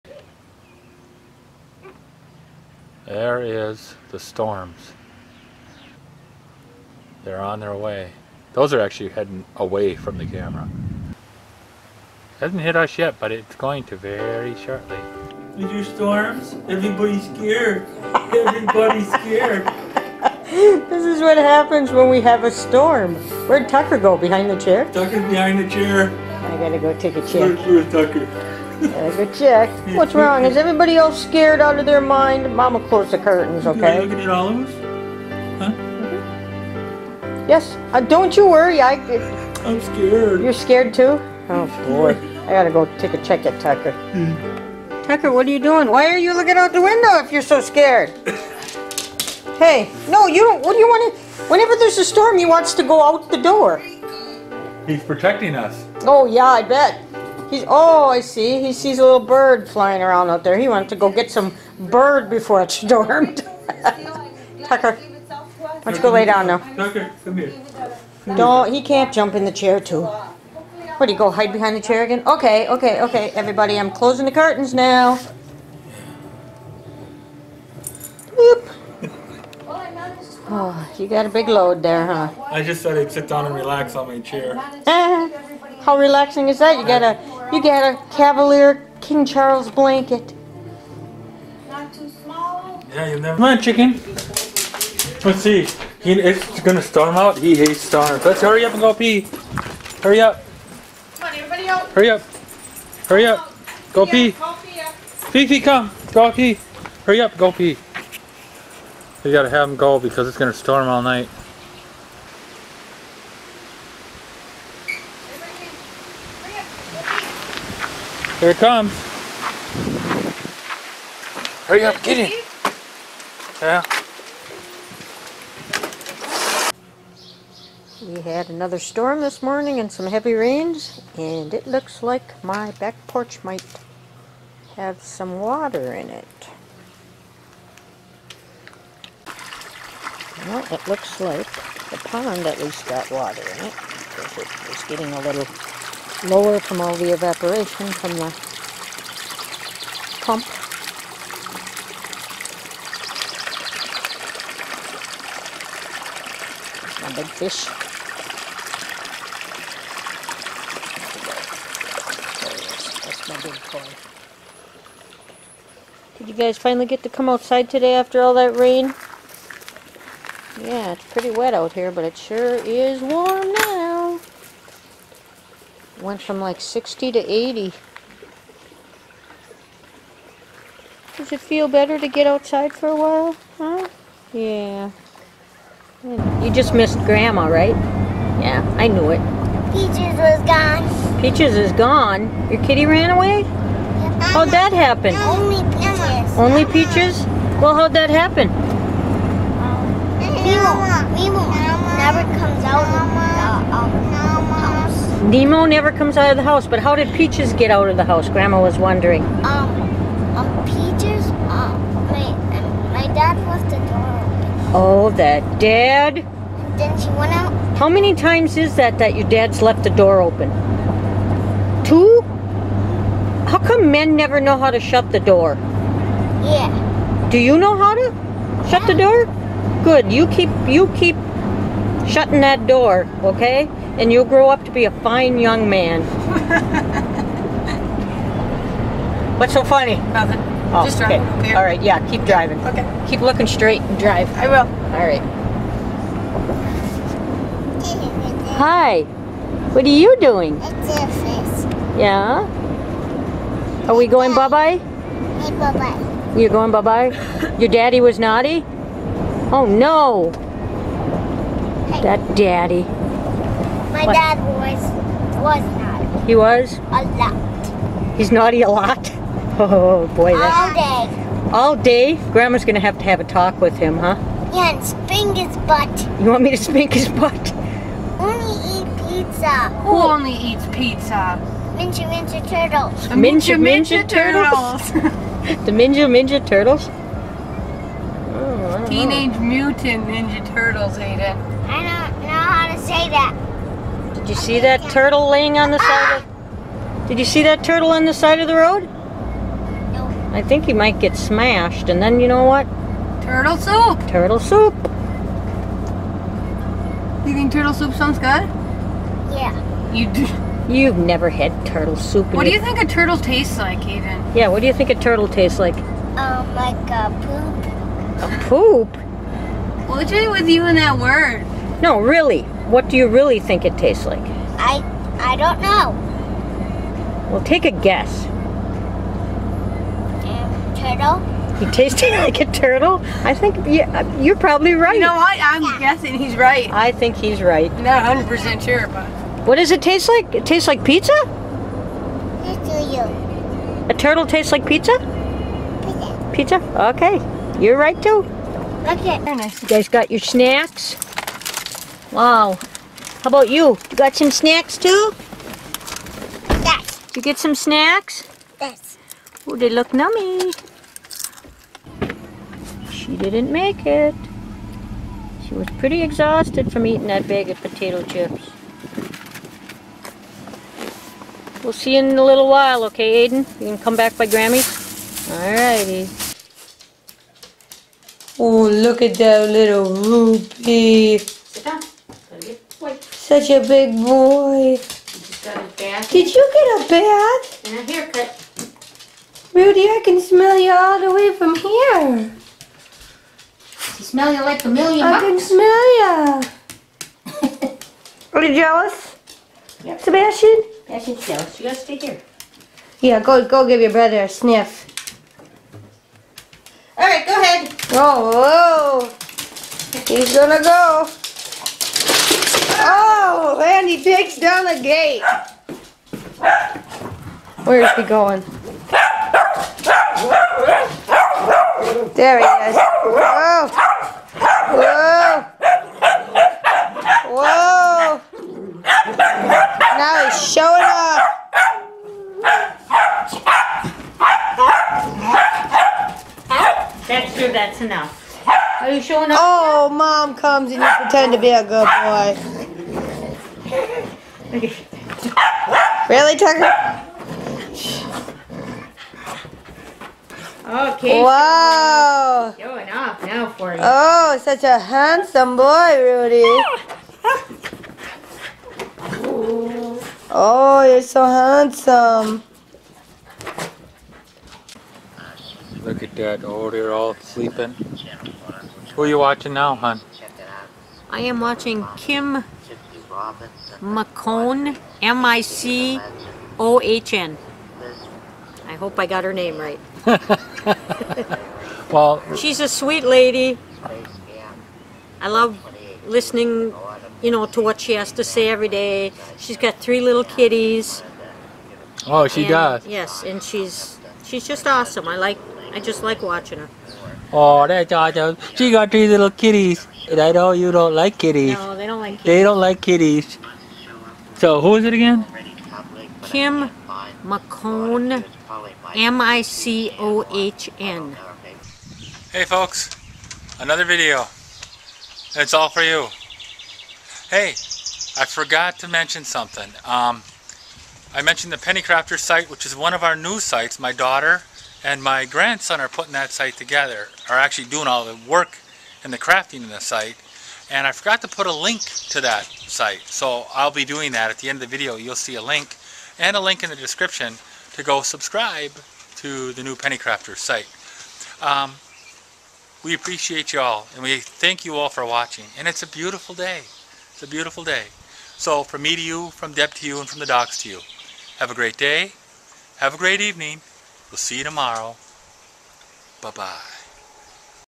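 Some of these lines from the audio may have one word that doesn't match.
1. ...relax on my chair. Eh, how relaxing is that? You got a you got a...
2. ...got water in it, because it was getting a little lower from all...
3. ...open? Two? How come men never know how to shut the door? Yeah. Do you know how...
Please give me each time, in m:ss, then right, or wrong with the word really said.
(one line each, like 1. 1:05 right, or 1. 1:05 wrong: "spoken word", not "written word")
1. 1:23 right
2. 2:22 right
3. 3:40 right.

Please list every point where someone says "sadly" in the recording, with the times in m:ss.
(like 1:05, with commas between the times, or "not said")
not said.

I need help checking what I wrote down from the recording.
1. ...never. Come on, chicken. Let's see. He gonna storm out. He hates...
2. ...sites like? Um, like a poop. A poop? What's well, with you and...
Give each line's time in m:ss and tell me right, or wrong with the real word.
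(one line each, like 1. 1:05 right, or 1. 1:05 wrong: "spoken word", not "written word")
1. 1:33 right
2. 5:15 wrong: "tastes", not "sites".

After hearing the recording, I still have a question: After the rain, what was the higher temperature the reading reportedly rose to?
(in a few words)
80.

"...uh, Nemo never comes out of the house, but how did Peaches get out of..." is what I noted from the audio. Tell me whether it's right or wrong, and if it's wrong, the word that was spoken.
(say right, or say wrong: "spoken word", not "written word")
right.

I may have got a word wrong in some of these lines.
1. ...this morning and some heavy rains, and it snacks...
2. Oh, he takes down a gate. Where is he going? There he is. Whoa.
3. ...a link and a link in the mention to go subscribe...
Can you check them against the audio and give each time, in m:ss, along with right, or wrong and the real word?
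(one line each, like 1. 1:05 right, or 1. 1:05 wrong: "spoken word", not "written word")
1. 2:09 wrong: "looks", not "snacks"
2. 6:52 right
3. 8:55 wrong: "description", not "mention".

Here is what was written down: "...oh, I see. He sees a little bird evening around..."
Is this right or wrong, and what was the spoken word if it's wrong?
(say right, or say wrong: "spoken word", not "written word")
wrong: "flying", not "evening".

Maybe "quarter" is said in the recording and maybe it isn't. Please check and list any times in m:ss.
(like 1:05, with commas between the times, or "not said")
not said.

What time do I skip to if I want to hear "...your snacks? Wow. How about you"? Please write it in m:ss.
5:50.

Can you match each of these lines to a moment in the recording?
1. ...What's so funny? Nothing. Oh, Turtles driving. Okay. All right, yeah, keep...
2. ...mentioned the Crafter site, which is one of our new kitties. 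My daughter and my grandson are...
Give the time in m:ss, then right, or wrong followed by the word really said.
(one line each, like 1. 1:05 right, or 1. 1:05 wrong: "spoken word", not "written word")
1. 3:59 wrong: "Just", not "Turtles"
2. 8:41 wrong: "sites", not "kitties".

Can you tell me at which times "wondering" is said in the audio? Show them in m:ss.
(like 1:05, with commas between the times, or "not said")
3:28.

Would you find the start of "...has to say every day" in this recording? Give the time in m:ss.
8:07.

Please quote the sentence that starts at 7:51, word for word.
I am watching Kim McCone, M-I-C-O-H-N.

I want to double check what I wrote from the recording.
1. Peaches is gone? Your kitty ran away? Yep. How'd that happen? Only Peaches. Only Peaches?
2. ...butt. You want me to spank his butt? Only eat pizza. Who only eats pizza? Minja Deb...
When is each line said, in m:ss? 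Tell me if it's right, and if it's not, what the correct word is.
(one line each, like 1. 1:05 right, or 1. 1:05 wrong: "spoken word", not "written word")
1. 3:11 right
2. 4:35 wrong: "Minja", not "Deb".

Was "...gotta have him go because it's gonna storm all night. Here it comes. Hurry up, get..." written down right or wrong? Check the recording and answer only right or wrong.
right.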